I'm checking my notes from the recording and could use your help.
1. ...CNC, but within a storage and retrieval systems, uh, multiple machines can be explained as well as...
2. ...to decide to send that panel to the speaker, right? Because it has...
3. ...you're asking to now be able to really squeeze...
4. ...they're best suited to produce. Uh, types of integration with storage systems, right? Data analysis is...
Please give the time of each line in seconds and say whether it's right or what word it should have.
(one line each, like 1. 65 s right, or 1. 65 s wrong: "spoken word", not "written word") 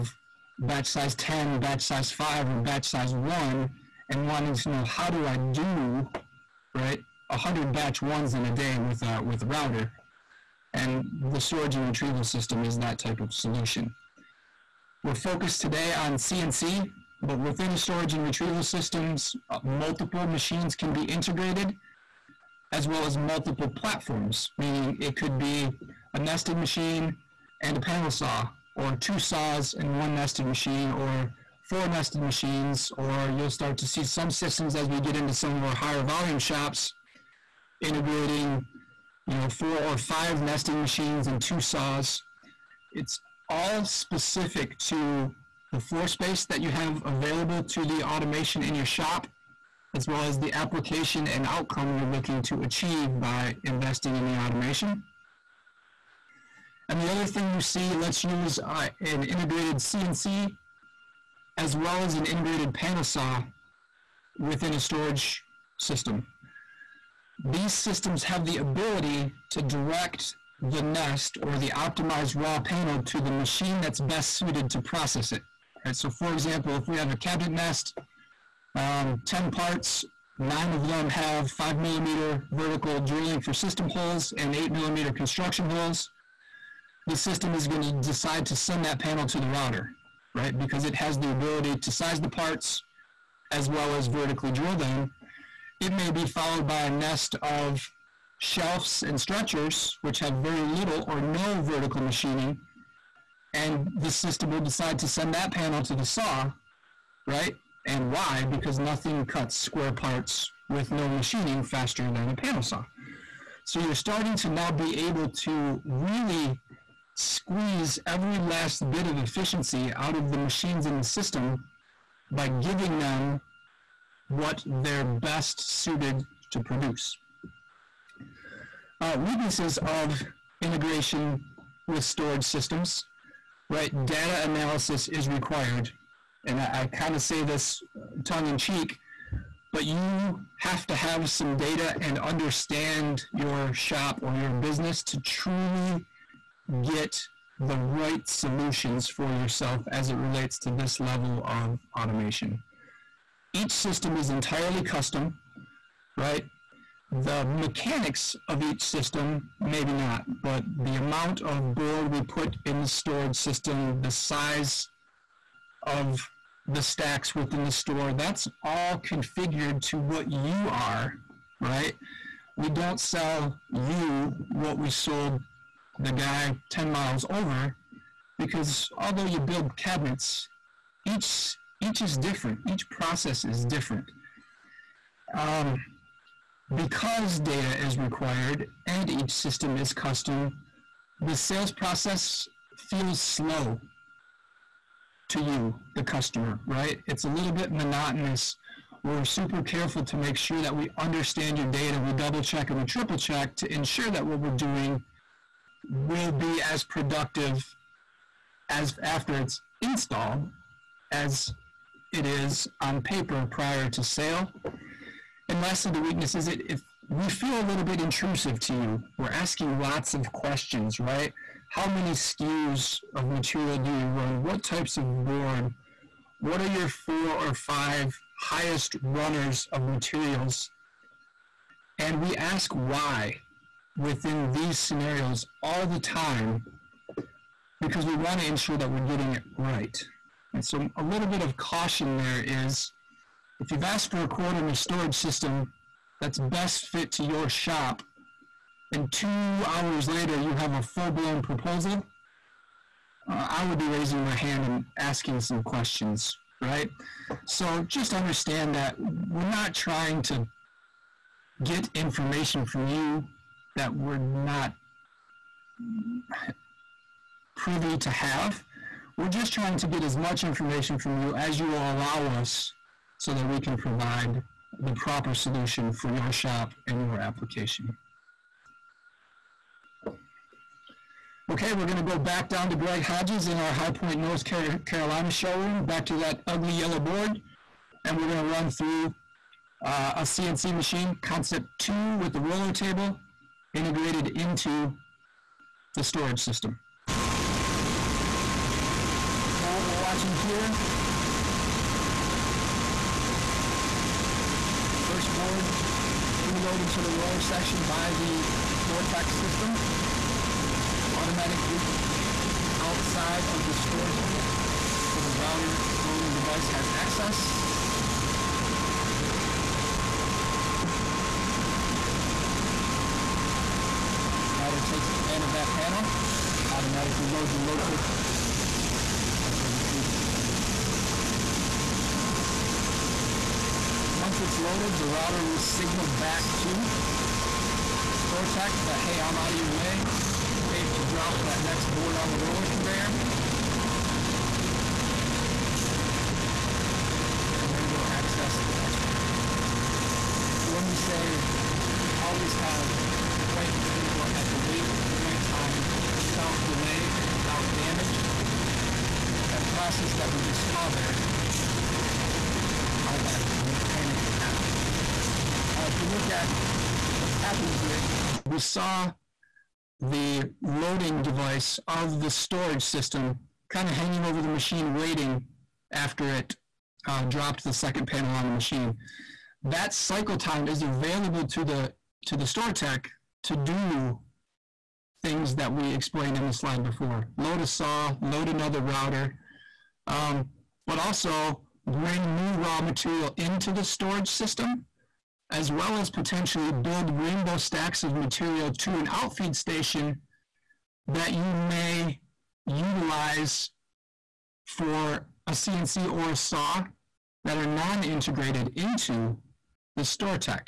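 1. 16 s wrong: "integrated", not "explained"
2. 87 s wrong: "router", not "speaker"
3. 113 s wrong: "starting", not "asking"
4. 124 s wrong: "weaknesses", not "types".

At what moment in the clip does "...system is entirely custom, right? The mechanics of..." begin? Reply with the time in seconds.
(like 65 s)
153 s.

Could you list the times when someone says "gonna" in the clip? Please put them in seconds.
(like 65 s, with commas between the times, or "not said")
281 s, 288 s.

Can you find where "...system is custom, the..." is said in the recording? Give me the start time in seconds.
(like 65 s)
189 s.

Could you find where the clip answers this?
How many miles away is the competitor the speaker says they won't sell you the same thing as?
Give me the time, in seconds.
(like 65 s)
176 s.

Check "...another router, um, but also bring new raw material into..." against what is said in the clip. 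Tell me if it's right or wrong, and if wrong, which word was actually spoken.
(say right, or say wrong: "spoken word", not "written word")
right.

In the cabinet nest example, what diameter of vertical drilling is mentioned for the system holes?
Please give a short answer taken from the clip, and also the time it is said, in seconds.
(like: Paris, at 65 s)
5 millimeter, at 81 s.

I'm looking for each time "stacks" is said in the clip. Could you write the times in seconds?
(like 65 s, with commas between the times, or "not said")
166 s, 397 s.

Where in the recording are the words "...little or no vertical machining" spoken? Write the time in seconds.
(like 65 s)
100 s.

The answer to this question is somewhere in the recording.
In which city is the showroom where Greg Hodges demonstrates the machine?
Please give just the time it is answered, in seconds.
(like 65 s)
283 s.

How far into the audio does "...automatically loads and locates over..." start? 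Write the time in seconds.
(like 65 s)
326 s.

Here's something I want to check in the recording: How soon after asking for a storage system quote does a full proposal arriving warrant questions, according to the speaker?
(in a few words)
2 hours.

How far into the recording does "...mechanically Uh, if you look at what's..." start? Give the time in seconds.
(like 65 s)
363 s.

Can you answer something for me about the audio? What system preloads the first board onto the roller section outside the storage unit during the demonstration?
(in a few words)
Vortex.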